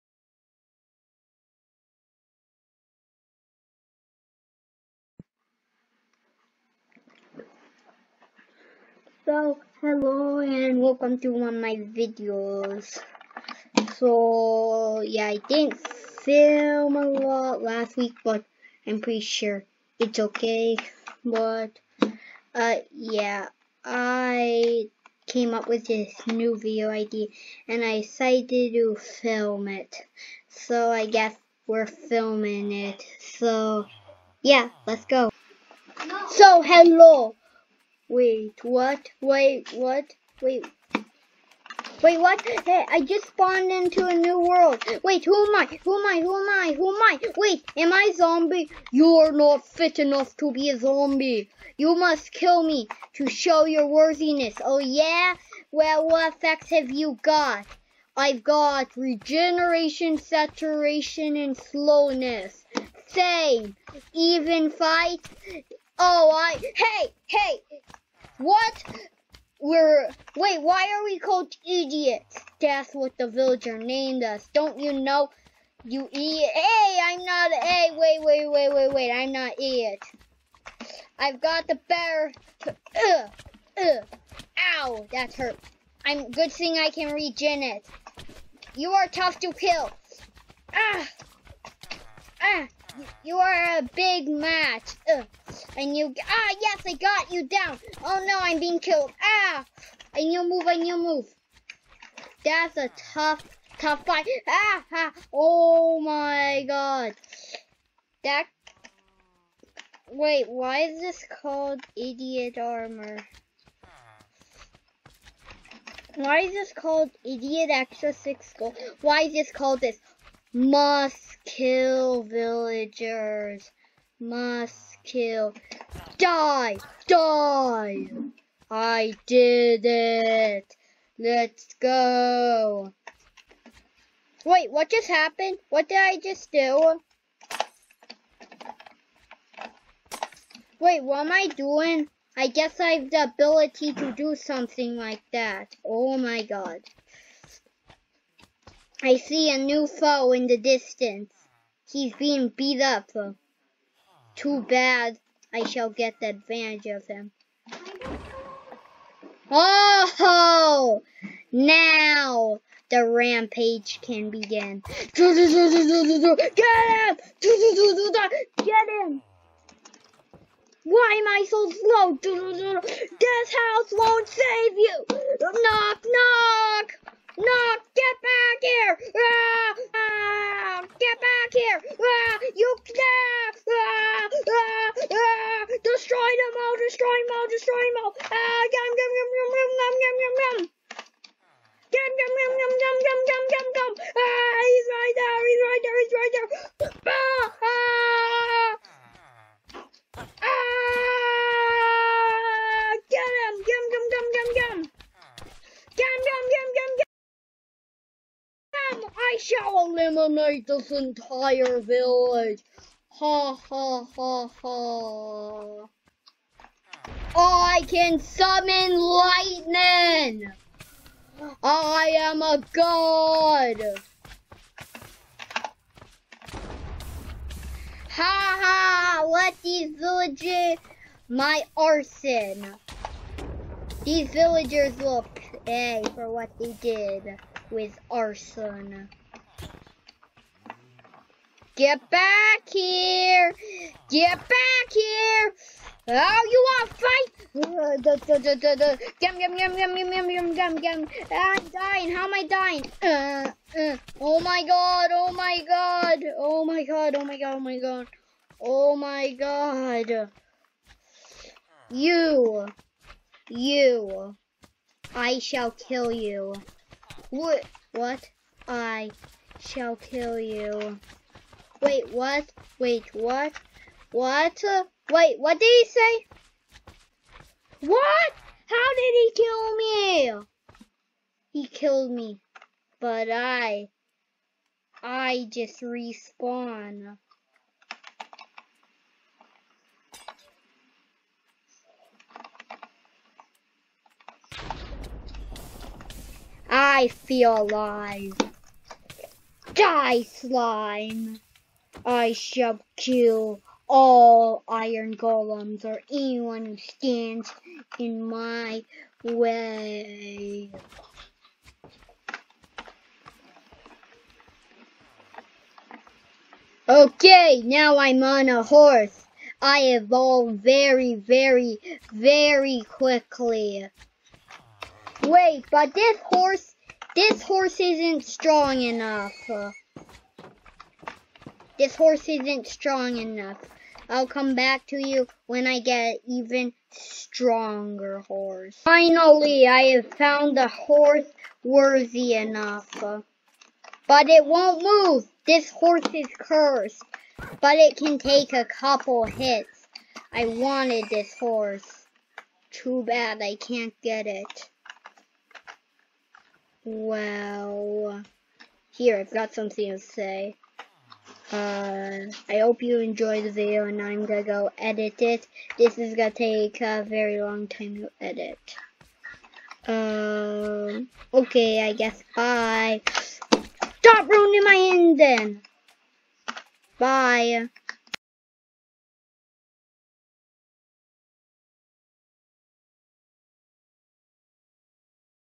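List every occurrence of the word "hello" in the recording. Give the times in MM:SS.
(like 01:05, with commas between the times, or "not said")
00:09, 00:36.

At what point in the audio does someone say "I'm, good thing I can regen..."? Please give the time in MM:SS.
01:26.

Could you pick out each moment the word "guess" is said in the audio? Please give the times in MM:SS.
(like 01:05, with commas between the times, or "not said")
00:31, 02:22, 06:11.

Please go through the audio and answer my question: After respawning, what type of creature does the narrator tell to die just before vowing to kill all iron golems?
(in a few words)
Slime.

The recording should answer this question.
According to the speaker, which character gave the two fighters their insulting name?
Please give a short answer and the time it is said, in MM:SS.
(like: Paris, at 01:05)
The villager, at 01:13.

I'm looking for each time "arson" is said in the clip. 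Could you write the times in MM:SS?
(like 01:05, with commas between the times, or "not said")
03:51, 03:58.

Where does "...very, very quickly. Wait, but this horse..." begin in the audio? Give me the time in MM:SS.
05:21.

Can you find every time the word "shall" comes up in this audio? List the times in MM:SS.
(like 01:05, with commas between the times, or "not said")
02:35, 03:29, 04:25, 04:29, 05:02.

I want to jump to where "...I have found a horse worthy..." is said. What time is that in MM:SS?
05:39.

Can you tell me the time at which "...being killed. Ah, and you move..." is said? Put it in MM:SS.
01:38.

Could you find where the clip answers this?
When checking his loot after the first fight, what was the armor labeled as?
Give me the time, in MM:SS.
01:51.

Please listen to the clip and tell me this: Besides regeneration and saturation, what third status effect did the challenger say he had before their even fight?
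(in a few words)
Slowness.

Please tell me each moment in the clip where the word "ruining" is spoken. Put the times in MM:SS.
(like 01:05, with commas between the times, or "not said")
06:14.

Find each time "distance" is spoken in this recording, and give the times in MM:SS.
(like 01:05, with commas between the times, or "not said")
02:30.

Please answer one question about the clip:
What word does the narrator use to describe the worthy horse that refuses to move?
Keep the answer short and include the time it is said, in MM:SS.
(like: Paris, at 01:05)
Cursed, at 05:46.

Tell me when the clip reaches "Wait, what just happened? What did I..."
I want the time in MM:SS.
02:14.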